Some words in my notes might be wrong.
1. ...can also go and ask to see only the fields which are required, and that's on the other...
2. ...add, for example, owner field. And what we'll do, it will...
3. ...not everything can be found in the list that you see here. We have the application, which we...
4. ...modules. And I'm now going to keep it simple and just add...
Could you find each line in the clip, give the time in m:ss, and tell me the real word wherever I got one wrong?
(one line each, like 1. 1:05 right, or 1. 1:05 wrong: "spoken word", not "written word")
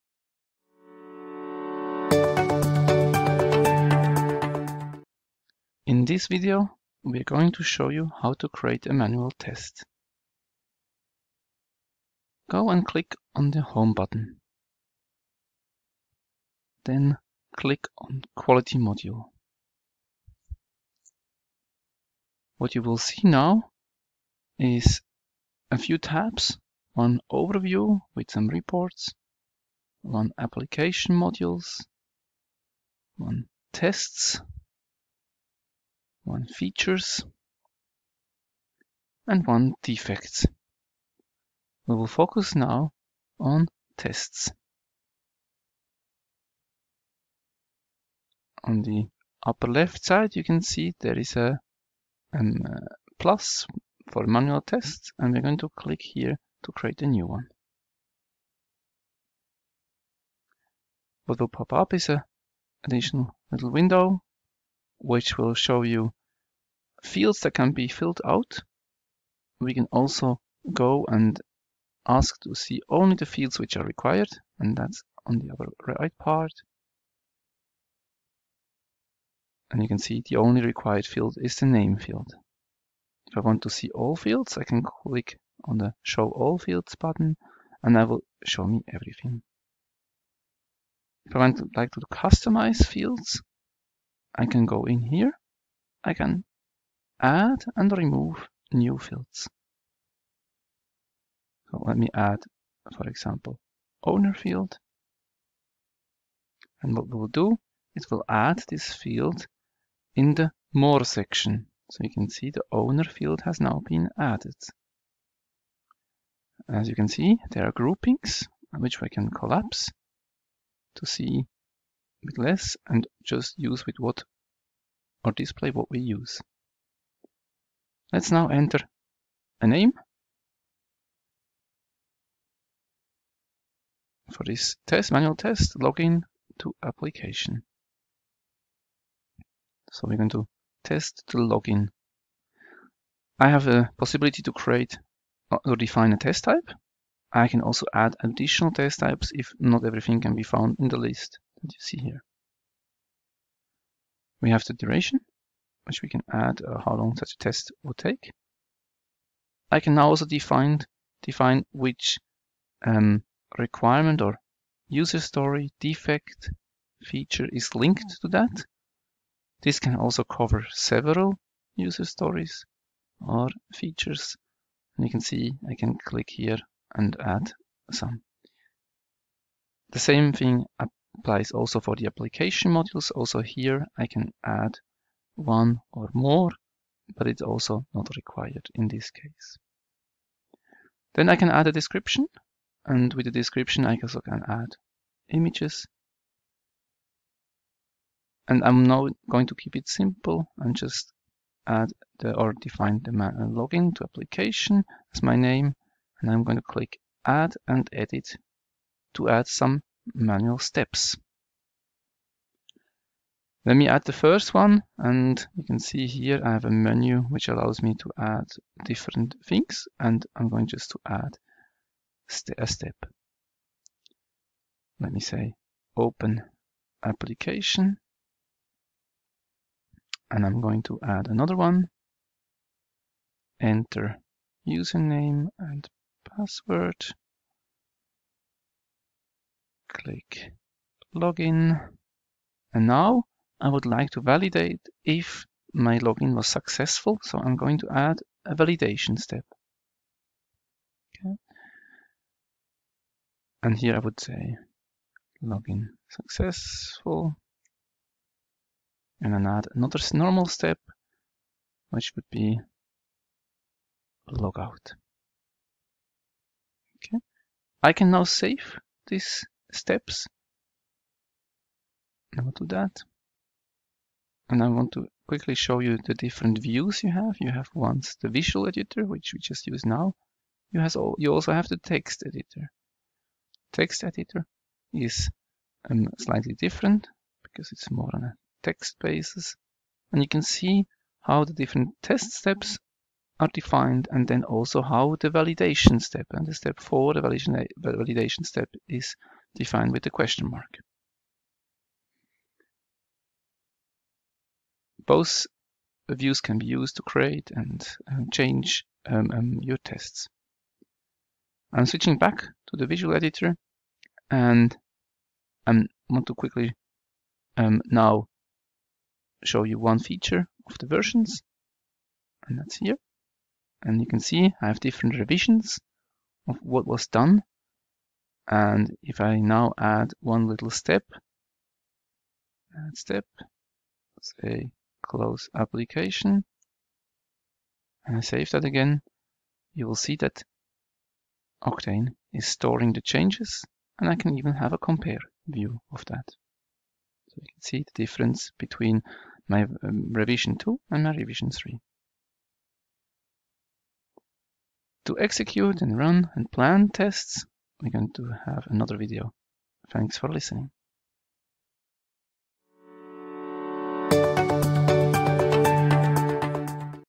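1. 1:09 right
2. 1:42 right
3. 2:29 wrong: "duration", not "application"
4. 3:15 wrong: "images", not "modules".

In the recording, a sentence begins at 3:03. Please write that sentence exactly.
Also here I can add one or more, but it's also not required in this case.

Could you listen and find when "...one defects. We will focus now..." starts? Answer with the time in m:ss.
0:39.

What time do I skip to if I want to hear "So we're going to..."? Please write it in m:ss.
2:19.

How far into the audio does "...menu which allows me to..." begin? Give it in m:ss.
3:36.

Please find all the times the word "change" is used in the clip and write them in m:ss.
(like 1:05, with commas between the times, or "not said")
5:08, 5:43.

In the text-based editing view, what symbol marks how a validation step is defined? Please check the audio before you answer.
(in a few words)
question mark.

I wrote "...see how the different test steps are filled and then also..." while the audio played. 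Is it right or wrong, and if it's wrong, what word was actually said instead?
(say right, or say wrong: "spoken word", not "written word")
wrong: "defined", not "filled".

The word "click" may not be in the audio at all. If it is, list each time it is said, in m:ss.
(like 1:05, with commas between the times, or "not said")
0:12, 0:17, 0:55, 1:24, 2:56, 3:26, 3:59.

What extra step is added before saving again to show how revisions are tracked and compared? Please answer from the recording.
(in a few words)
close application.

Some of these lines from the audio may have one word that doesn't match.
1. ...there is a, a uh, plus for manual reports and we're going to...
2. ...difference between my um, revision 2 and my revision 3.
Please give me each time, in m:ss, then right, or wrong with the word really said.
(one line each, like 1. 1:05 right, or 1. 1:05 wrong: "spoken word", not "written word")
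1. 0:51 wrong: "tests", not "reports"
2. 5:47 right.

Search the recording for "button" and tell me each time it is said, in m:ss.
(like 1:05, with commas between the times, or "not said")
0:13, 1:26.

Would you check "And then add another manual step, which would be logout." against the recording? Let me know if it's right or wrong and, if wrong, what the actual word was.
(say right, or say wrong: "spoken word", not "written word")
wrong: "normal", not "manual".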